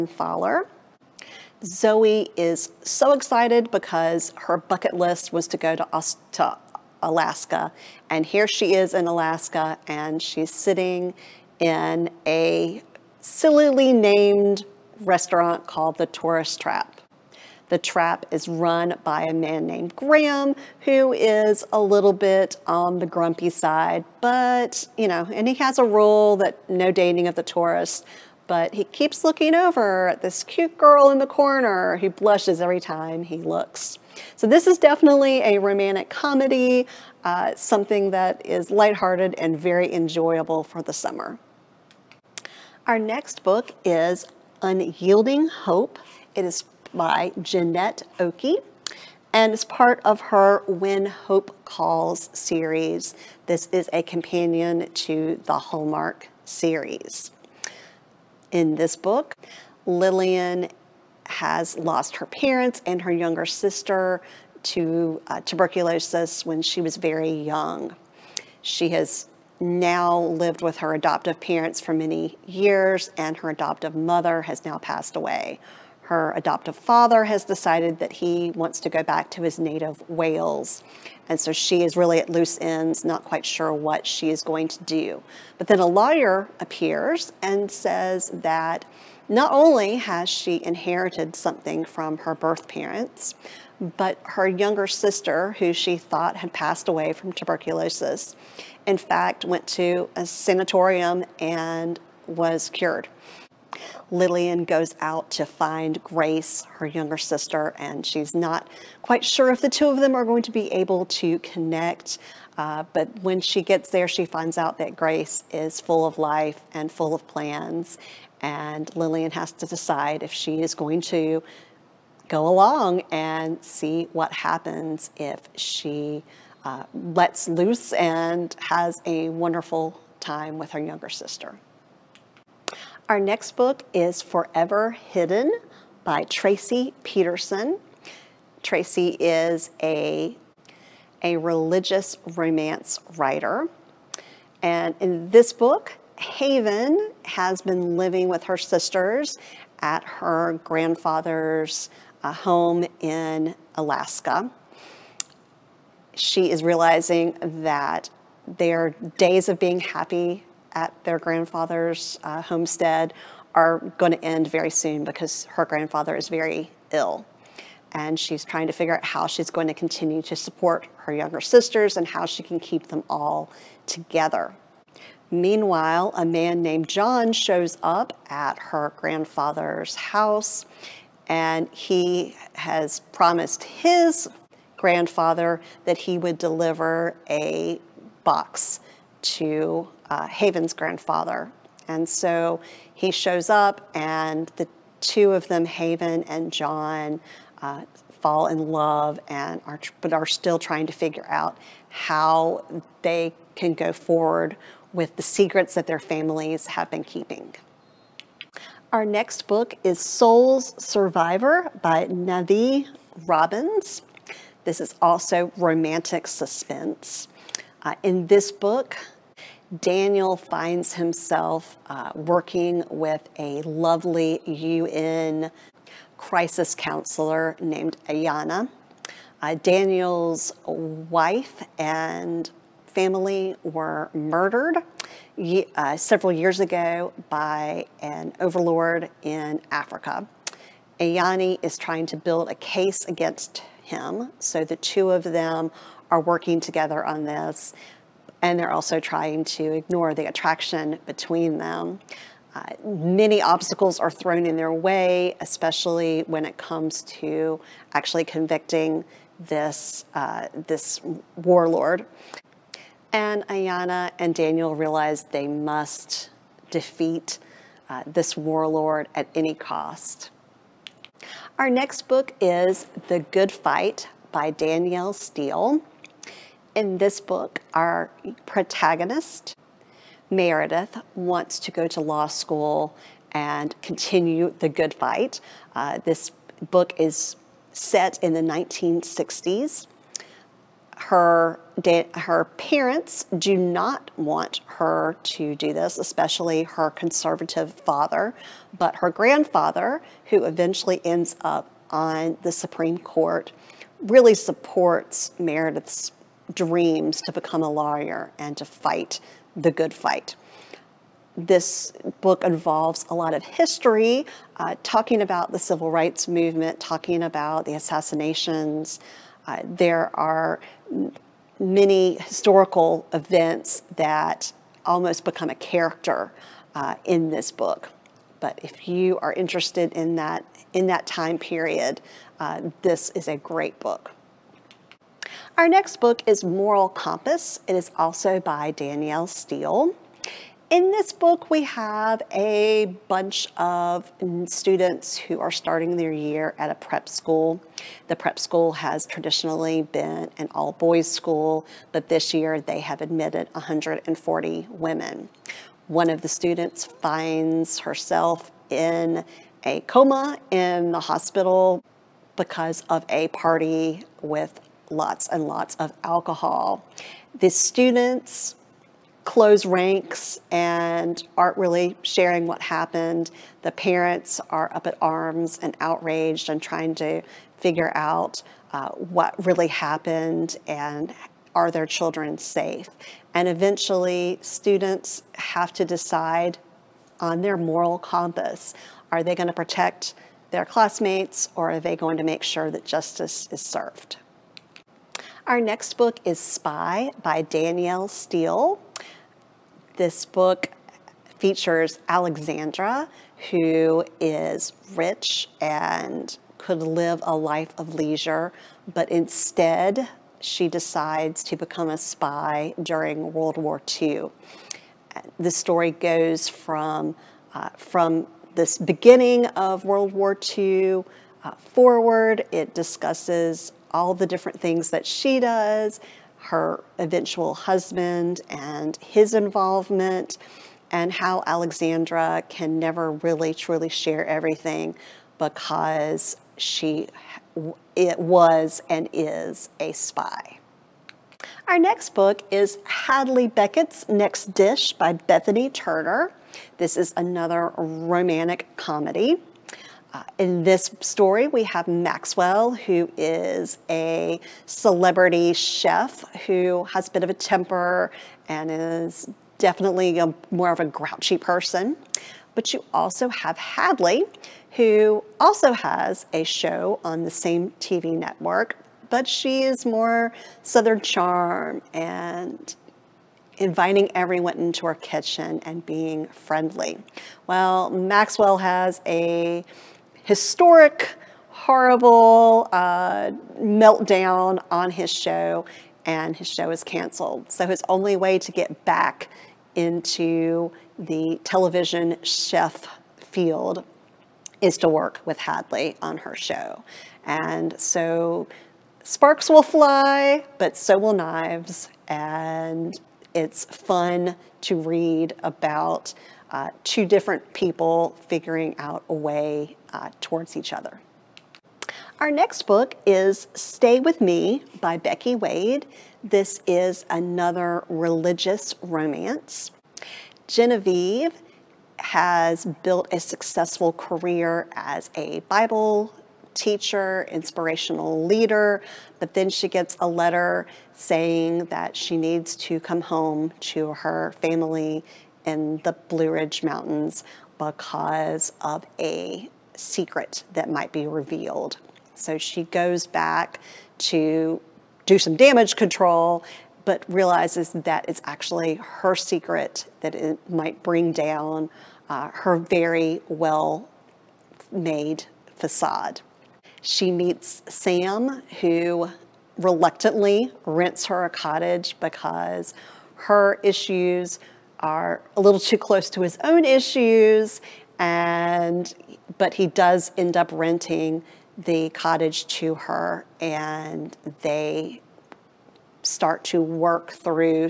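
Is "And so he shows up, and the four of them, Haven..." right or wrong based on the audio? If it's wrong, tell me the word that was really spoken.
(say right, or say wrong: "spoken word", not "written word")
wrong: "two", not "four".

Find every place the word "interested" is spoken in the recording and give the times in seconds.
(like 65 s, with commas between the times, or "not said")
329 s.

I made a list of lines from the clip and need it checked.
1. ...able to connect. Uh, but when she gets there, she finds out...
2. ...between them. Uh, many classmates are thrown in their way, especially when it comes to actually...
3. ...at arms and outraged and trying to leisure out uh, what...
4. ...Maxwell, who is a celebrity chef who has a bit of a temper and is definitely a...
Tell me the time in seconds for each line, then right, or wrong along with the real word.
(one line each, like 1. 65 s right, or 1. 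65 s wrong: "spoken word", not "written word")
1. 110 s right
2. 251 s wrong: "obstacles", not "classmates"
3. 374 s wrong: "figure", not "leisure"
4. 451 s right.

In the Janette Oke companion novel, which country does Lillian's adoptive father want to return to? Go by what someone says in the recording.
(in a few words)
Wales.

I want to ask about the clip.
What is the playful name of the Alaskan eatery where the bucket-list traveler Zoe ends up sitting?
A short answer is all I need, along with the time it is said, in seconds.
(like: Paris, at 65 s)
The Tourist Trap, at 15 s.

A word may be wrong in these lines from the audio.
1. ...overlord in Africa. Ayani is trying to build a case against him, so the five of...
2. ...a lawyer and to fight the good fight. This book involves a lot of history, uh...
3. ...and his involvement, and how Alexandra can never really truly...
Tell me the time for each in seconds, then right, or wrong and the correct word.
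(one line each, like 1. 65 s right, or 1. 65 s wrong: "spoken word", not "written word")
1. 238 s wrong: "two", not "five"
2. 307 s right
3. 428 s right.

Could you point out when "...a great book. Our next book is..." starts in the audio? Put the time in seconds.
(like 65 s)
333 s.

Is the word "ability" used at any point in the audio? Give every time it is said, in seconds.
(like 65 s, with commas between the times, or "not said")
not said.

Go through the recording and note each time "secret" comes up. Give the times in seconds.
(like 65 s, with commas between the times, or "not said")
205 s, 539 s, 549 s.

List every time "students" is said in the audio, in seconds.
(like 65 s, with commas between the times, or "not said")
344 s, 356 s, 367 s, 384 s.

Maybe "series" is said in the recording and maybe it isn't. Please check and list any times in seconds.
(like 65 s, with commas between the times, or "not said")
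52 s, 56 s.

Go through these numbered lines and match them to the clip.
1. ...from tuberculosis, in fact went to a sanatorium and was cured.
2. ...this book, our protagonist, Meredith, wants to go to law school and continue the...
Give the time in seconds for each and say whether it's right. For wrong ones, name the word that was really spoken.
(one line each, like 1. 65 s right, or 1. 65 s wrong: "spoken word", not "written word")
1. 97 s right
2. 276 s right.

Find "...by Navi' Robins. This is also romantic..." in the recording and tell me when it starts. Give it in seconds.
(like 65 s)
211 s.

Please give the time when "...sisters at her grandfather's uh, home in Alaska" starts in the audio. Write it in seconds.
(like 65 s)
148 s.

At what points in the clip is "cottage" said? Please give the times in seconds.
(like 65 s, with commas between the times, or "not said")
561 s, 571 s.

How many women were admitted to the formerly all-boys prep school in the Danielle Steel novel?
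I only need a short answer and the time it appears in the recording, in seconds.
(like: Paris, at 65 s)
140, at 353 s.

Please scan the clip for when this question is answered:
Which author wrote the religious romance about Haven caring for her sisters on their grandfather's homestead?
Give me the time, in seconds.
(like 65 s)
136 s.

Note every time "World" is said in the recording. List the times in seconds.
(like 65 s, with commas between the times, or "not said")
413 s, 419 s.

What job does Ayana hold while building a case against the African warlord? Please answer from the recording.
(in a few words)
UN crisis counselor.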